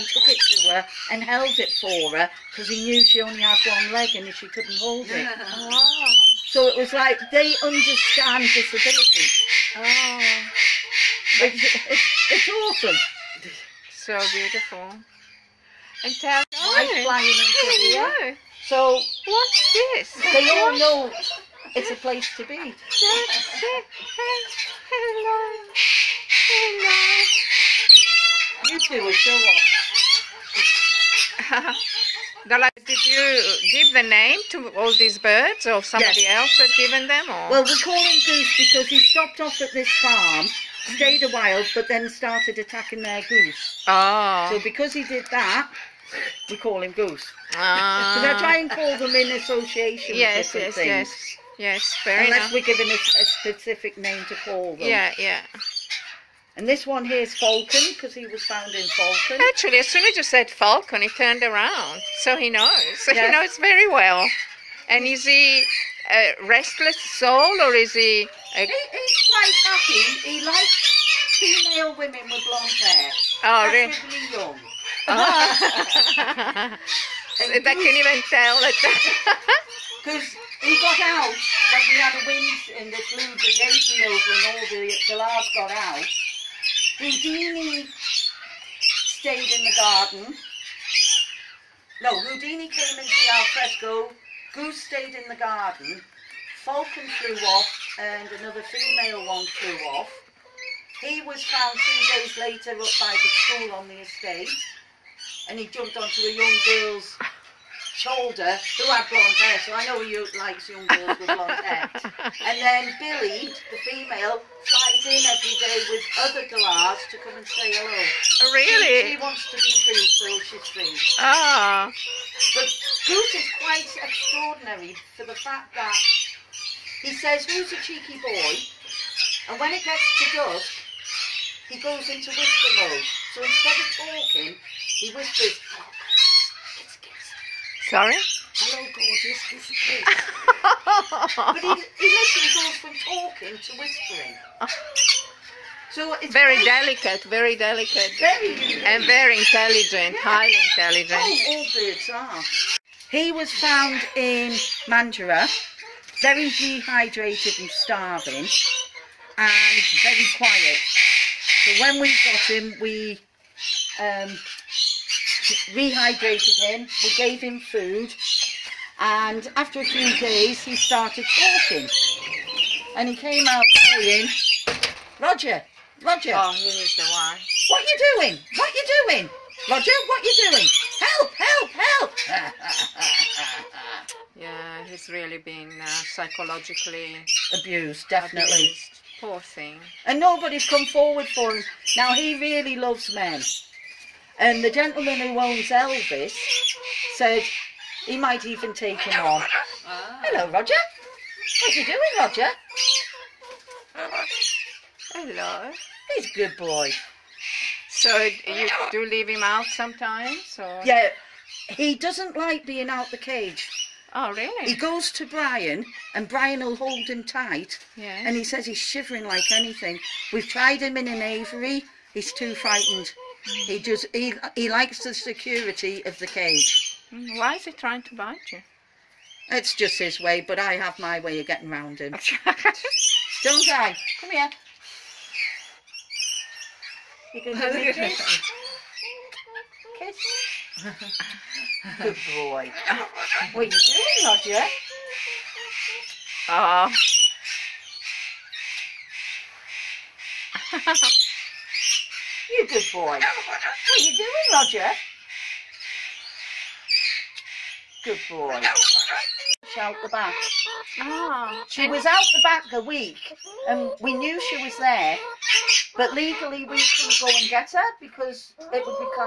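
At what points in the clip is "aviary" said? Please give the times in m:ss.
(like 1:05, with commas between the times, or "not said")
3:41.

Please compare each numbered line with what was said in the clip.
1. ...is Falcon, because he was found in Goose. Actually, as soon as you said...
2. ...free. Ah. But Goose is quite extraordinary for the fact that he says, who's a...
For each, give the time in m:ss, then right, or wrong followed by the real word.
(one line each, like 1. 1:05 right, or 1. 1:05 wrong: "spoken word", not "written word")
1. 0:57 wrong: "Falcon", not "Goose"
2. 2:00 right.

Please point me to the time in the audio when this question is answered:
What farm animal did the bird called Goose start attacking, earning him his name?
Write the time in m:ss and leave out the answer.
0:42.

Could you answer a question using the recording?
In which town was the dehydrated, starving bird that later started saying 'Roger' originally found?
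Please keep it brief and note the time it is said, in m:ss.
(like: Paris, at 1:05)
Mandurah, at 2:34.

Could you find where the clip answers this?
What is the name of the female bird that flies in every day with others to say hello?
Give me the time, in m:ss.
1:52.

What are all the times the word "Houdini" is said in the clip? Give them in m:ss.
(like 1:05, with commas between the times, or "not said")
1:26, 1:32.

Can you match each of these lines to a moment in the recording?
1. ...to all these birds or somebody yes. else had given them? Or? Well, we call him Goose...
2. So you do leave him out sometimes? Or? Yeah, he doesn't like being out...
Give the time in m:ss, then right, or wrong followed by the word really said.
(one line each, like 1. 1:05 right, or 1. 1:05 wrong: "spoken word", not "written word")
1. 0:34 right
2. 3:27 right.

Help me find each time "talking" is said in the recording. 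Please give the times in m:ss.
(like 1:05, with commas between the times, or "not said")
2:14, 2:22, 2:51.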